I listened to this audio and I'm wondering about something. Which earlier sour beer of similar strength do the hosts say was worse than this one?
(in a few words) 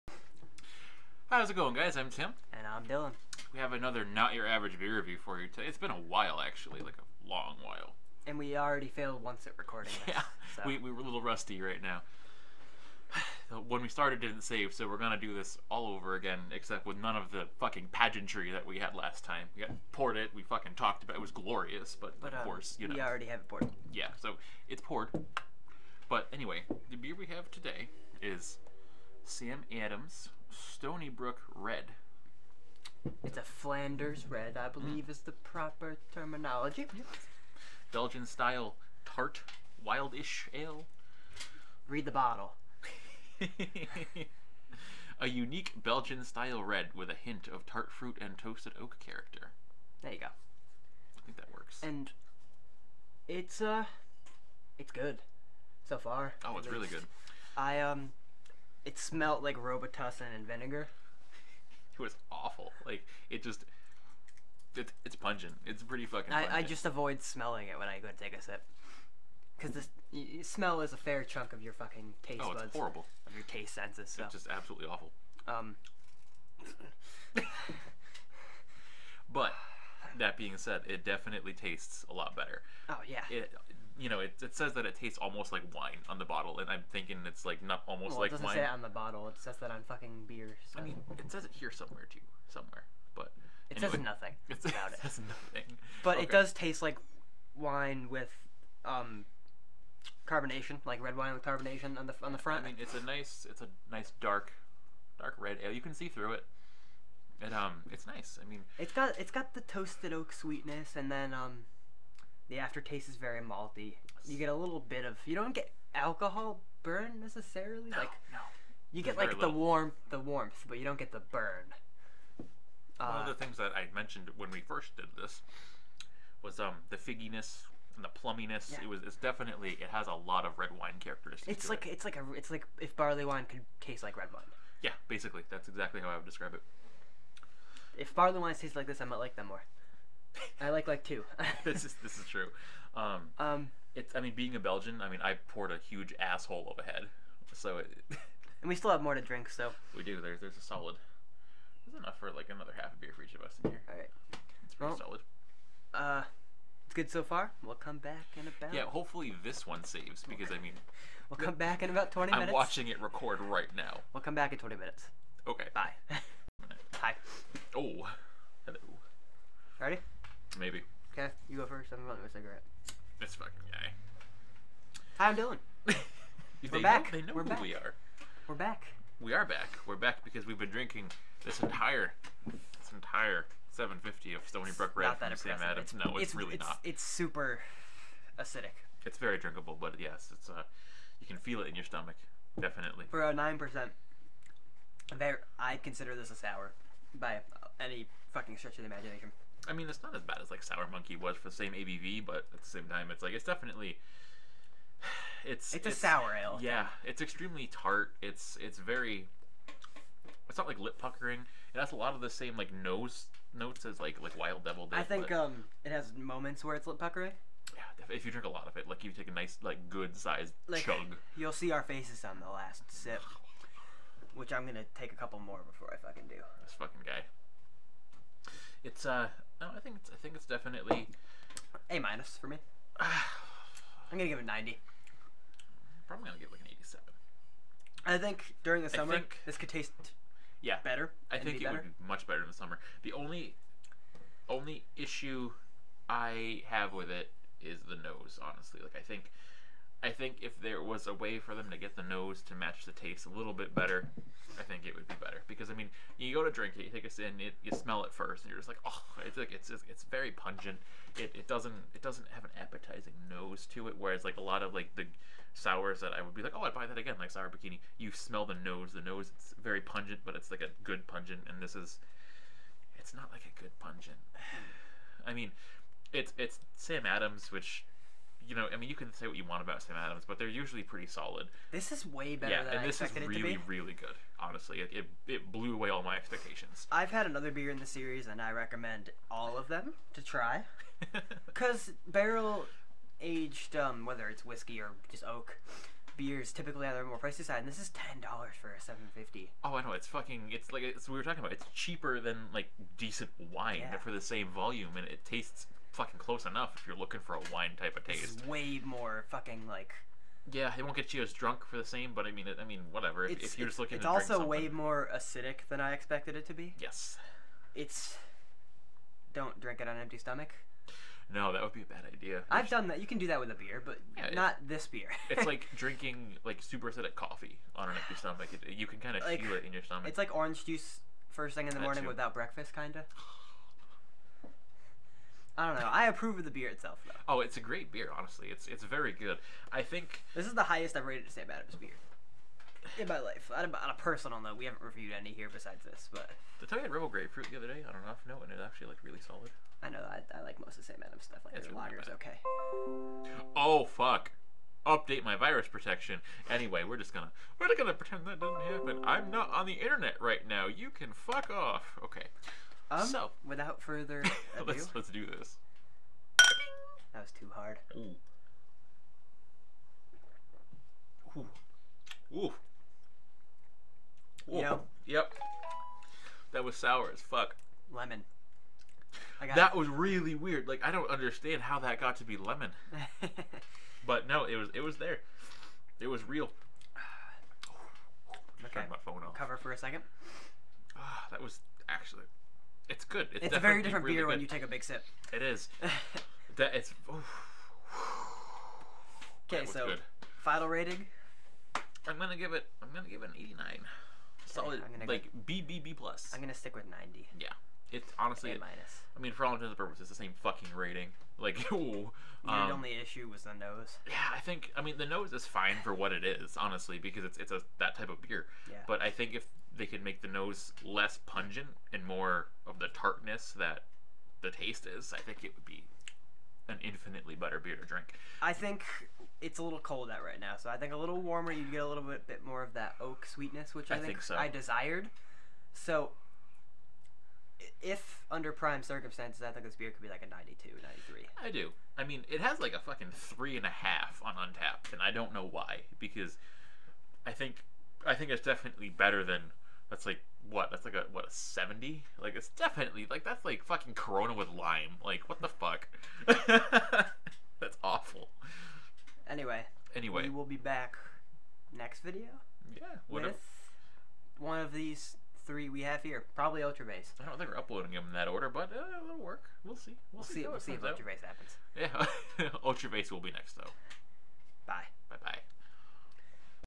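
Sour Monkey.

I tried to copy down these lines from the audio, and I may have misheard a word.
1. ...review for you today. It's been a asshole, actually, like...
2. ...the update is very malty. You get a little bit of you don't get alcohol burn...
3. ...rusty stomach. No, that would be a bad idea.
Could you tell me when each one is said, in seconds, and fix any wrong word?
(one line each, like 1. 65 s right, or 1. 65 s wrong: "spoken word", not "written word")
1. 4 s wrong: "while", not "asshole"
2. 112 s wrong: "aftertaste", not "update"
3. 320 s wrong: "empty", not "rusty".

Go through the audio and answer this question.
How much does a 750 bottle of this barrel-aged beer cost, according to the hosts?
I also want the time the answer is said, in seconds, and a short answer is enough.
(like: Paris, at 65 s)
$10, at 297 s.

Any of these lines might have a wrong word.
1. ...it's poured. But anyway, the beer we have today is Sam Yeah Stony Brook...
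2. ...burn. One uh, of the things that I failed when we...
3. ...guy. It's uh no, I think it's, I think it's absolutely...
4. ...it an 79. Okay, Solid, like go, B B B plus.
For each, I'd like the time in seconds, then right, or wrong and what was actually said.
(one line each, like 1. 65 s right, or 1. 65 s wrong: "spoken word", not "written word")
1. 24 s wrong: "Adams", not "Yeah"
2. 121 s wrong: "mentioned", not "failed"
3. 227 s wrong: "definitely", not "absolutely"
4. 403 s wrong: "89", not "79".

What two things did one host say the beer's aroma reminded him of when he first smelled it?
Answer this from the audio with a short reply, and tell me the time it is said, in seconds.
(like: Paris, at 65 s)
Robitussin and vinegar, at 59 s.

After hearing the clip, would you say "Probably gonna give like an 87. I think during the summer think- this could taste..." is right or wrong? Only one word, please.
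right.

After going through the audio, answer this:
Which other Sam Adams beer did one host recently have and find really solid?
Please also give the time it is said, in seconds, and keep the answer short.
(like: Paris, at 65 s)
Rebel Grapefruit, at 346 s.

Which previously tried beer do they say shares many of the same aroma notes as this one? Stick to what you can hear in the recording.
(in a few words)
Wild Devil.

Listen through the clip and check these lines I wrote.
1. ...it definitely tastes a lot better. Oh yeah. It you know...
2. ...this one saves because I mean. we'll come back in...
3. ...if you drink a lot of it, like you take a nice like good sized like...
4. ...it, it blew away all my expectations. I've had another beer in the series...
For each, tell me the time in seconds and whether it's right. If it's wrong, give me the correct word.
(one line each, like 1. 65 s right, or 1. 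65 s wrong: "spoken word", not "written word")
1. 80 s right
2. 159 s right
3. 218 s right
4. 284 s right.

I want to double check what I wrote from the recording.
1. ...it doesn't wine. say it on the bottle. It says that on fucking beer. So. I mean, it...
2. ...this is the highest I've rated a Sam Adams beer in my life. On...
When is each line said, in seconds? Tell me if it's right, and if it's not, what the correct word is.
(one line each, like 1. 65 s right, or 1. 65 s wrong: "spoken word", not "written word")
1. 88 s right
2. 340 s right.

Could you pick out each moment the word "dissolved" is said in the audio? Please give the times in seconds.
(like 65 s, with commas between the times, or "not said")
not said.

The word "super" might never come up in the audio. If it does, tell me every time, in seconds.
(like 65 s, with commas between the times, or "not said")
187 s, 326 s.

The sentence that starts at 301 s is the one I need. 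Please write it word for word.
It's cheaper than like decent wine yeah.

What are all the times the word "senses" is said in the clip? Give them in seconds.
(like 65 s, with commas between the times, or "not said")
73 s.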